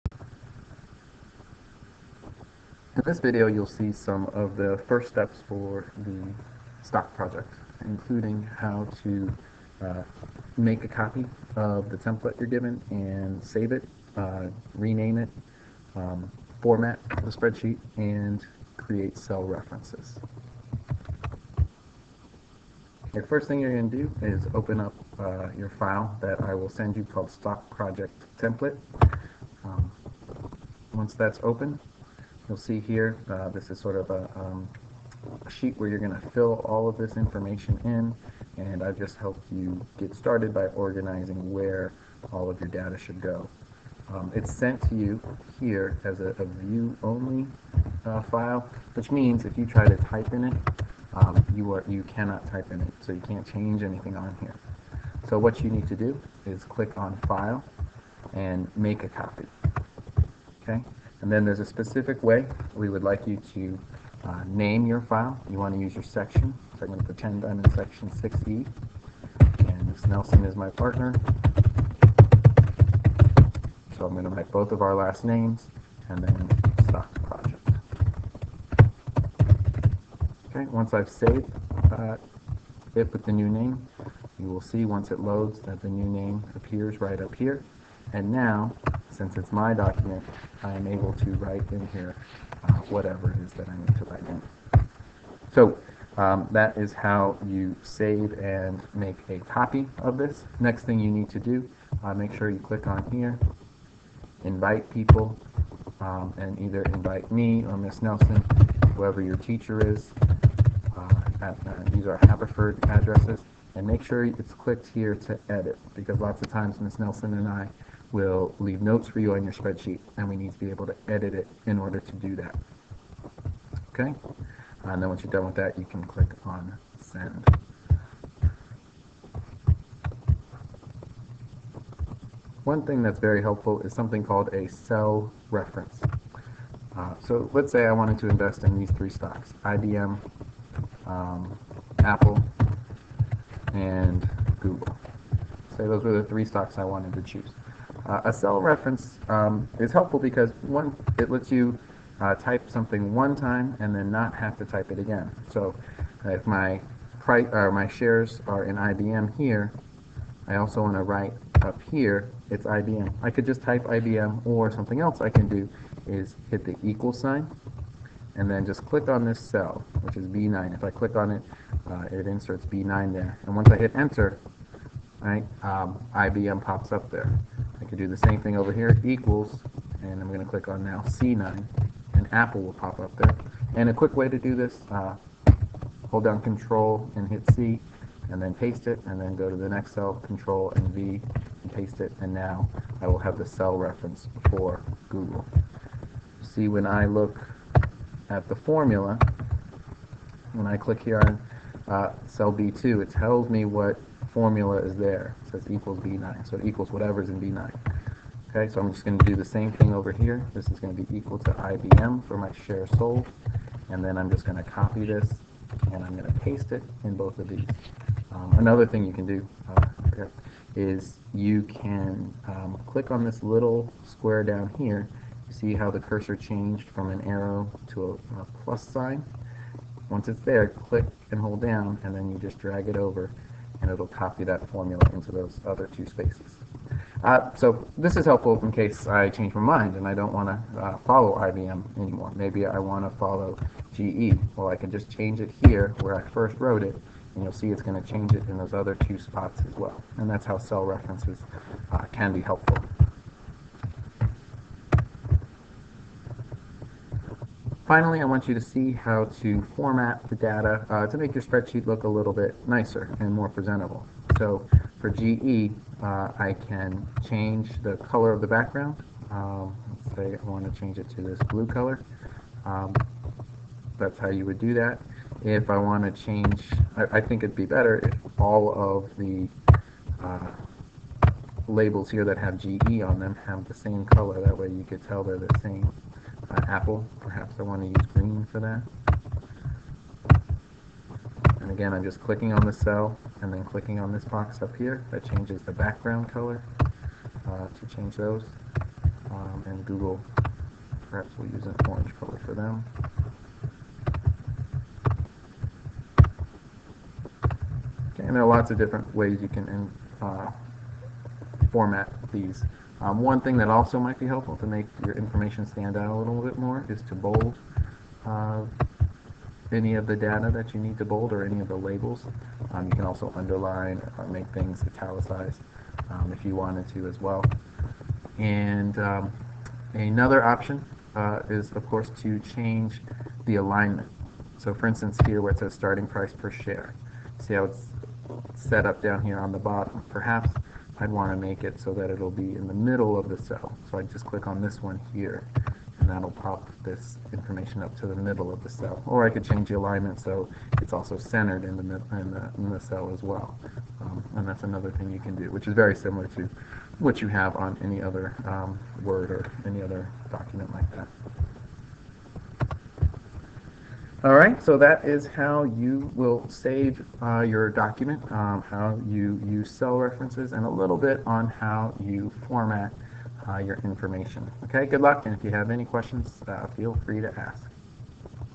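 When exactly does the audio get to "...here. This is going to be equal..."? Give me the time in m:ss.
3:30.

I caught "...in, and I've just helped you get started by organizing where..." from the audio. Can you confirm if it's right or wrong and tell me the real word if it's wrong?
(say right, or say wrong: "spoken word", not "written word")
right.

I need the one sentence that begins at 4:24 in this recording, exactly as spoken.
So for GE, uh, I can change the color of the background.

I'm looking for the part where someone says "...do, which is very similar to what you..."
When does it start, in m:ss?
5:55.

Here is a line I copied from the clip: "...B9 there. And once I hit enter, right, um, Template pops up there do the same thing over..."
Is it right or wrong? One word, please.
wrong.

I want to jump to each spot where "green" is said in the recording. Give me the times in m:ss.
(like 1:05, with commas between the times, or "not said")
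4:48.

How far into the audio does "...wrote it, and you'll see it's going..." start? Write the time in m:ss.
4:06.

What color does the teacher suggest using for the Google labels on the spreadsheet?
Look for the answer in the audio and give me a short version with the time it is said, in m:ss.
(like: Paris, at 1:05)
orange, at 5:01.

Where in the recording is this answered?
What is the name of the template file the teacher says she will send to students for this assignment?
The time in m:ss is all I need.
0:27.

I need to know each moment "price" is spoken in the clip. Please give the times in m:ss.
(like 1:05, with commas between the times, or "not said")
2:37, 5:36.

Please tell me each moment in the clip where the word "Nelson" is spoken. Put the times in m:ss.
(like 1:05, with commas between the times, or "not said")
1:10, 1:48, 1:56.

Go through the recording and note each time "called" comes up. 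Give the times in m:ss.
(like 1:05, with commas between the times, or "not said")
0:27, 2:14.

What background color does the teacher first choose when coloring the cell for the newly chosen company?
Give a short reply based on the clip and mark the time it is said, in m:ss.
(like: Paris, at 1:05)
blue, at 4:31.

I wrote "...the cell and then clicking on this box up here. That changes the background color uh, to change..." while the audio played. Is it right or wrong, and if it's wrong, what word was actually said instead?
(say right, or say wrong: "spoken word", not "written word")
right.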